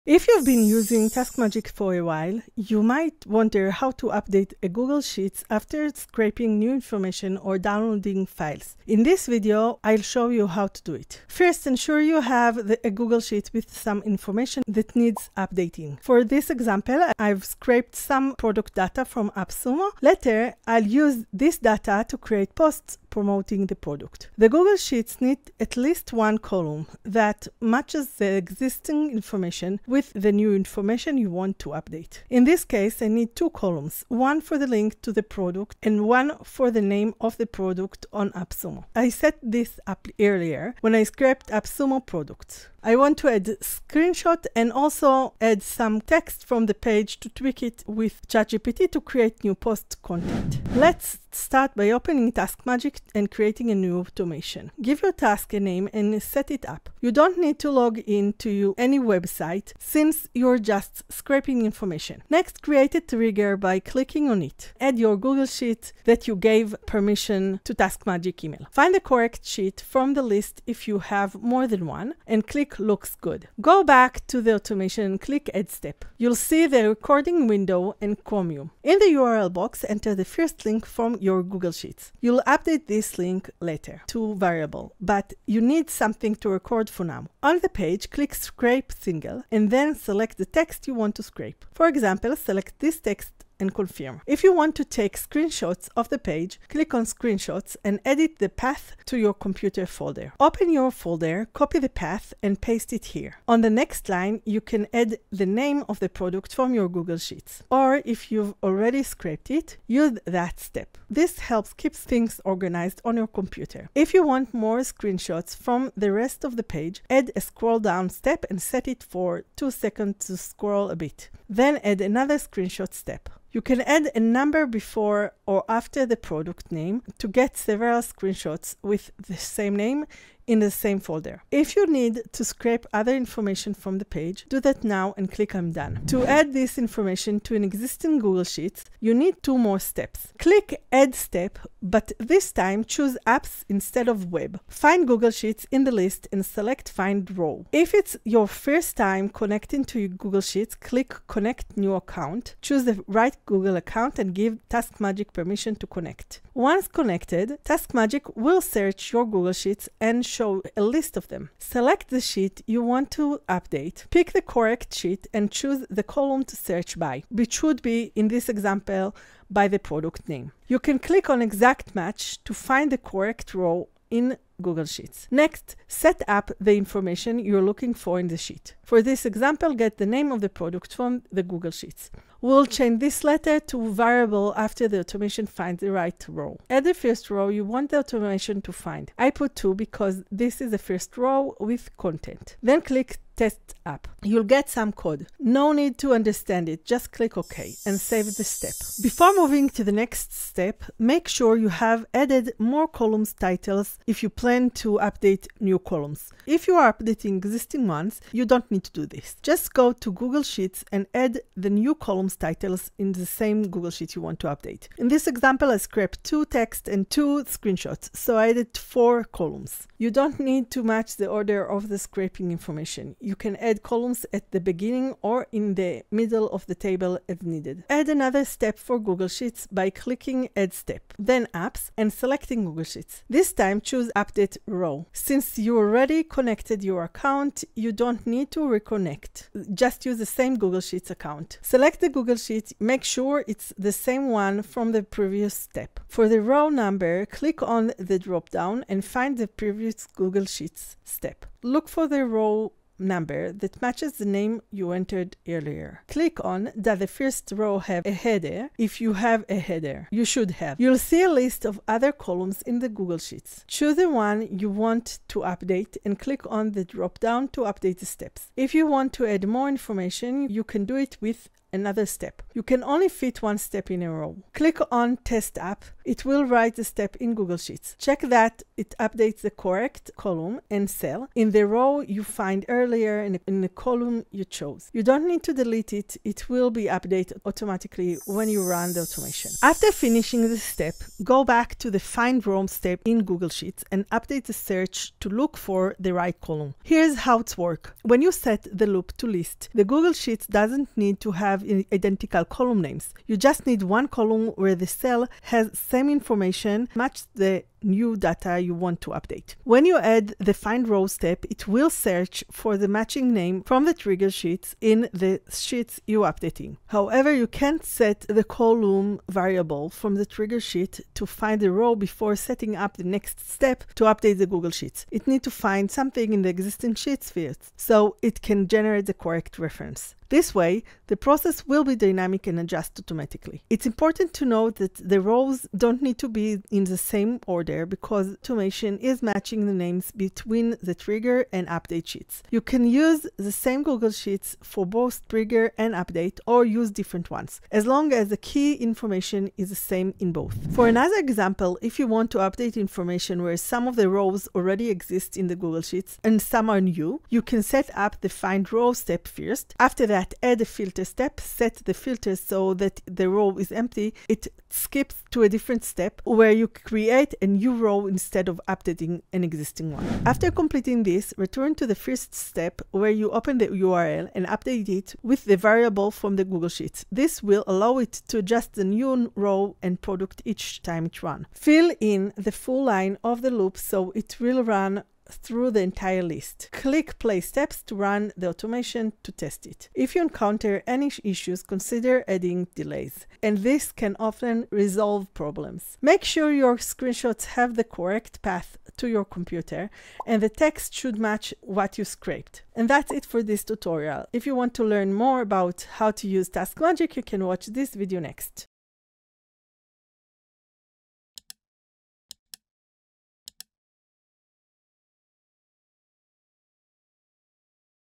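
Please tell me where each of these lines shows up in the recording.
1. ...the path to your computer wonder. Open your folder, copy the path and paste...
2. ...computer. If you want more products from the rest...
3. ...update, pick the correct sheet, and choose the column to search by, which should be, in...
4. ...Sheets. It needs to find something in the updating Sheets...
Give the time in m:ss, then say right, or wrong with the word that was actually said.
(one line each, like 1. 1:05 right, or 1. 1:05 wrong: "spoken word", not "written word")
1. 1:38 wrong: "folder", not "wonder"
2. 1:53 wrong: "screenshots", not "products"
3. 2:43 right
4. 5:24 wrong: "existing", not "updating".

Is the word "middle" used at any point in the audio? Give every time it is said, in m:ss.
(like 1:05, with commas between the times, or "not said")
3:46.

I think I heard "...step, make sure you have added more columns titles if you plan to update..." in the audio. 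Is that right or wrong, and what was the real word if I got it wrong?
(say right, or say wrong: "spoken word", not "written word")
right.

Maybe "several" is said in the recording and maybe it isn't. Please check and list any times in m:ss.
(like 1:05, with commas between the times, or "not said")
2:07.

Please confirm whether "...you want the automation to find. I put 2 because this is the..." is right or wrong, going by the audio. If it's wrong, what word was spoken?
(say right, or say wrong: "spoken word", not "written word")
right.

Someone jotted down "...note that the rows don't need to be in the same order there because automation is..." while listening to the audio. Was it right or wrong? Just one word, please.
right.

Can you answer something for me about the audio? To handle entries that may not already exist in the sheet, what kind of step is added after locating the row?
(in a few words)
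filter step.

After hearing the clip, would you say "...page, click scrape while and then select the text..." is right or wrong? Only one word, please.
wrong.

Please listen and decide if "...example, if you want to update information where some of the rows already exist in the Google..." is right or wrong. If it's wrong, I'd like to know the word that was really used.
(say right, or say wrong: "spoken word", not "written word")
right.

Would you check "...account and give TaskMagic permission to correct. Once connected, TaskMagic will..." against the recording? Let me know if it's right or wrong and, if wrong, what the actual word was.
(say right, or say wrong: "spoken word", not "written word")
wrong: "connect", not "correct".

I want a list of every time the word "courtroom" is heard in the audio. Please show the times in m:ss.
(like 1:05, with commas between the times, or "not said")
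not said.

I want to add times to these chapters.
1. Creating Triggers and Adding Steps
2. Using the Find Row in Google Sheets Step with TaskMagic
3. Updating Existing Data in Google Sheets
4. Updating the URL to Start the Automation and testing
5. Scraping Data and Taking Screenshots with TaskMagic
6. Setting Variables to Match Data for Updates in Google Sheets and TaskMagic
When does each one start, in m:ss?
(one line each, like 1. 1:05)
1. 0:50
2. 2:16
3. 3:18
4. 6:10
5. 1:27
6. 4:49.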